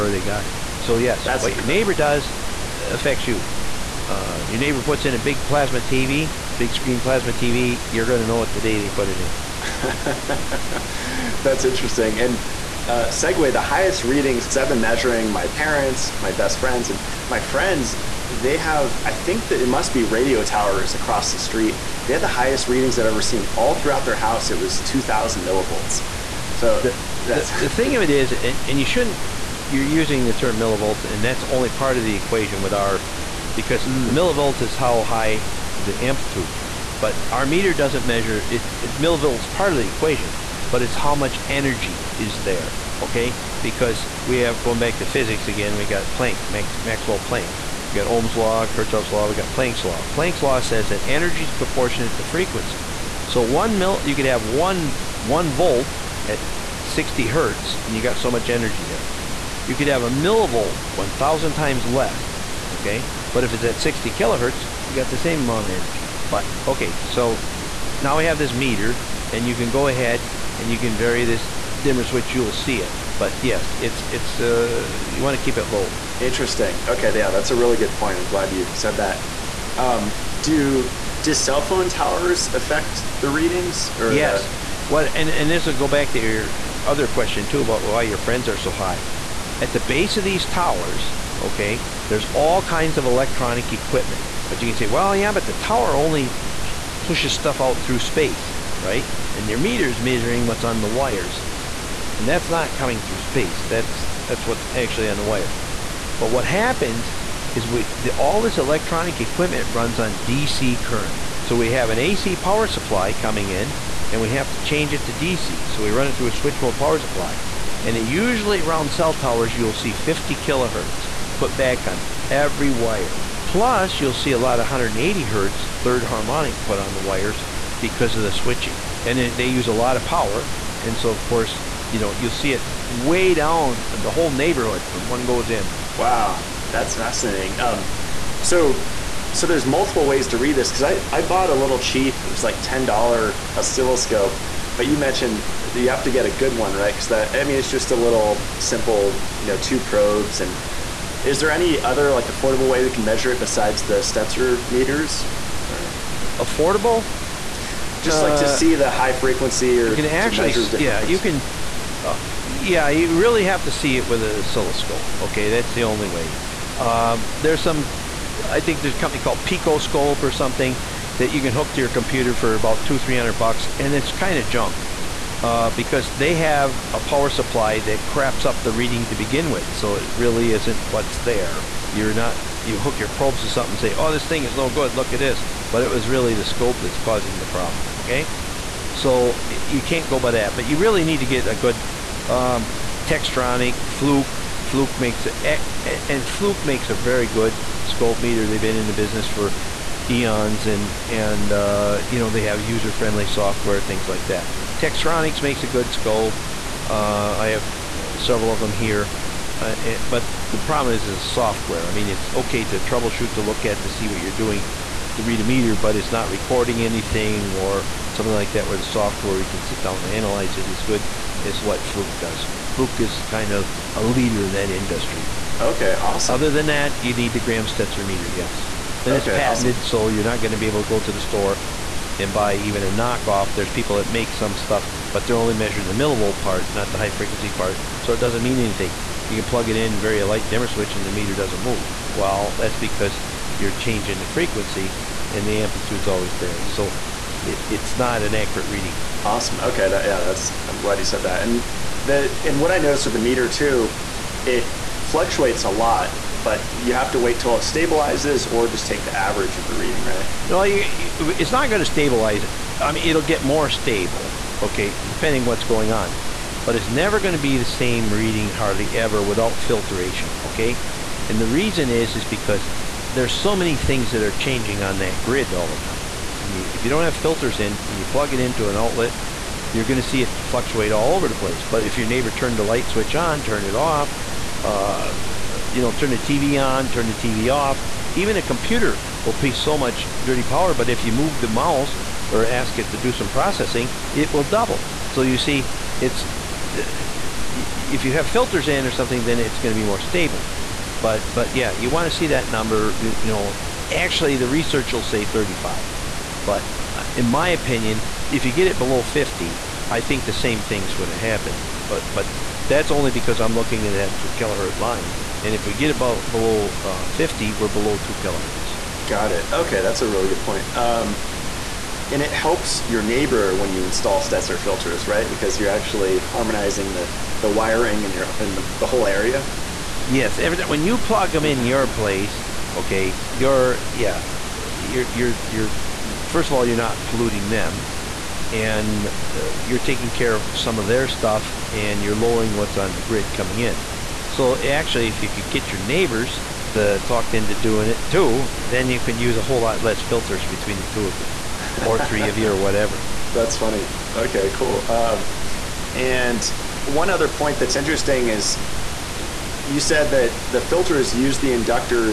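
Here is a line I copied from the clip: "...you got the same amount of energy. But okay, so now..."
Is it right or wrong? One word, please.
right.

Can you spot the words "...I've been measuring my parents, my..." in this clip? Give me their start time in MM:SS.
00:14.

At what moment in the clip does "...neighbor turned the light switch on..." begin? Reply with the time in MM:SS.
04:42.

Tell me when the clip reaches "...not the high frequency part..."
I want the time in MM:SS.
03:56.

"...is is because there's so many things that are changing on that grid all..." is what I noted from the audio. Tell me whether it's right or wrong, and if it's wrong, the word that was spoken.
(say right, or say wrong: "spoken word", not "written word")
right.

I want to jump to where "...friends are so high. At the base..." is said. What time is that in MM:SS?
01:28.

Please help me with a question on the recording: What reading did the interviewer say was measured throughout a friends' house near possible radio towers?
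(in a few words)
2,000 millivolts.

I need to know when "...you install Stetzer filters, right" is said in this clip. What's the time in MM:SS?
05:23.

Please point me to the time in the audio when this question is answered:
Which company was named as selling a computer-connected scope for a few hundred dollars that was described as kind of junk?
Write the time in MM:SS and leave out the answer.
02:49.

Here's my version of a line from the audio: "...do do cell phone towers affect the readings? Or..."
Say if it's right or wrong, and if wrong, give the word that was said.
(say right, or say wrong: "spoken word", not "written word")
right.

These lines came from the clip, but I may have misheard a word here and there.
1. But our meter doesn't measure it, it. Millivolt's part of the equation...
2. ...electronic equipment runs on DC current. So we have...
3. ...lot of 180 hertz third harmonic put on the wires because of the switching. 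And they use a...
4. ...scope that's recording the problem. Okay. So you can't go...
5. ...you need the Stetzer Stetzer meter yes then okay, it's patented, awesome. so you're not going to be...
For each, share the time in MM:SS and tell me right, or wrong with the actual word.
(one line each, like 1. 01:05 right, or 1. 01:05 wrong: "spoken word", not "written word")
1. 00:36 right
2. 01:48 right
3. 02:04 right
4. 03:06 wrong: "causing", not "recording"
5. 03:47 wrong: "Graham", not "Stetzer".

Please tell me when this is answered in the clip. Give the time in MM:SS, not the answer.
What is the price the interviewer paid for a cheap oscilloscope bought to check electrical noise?
02:22.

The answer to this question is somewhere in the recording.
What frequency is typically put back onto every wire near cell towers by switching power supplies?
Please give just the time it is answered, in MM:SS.
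01:59.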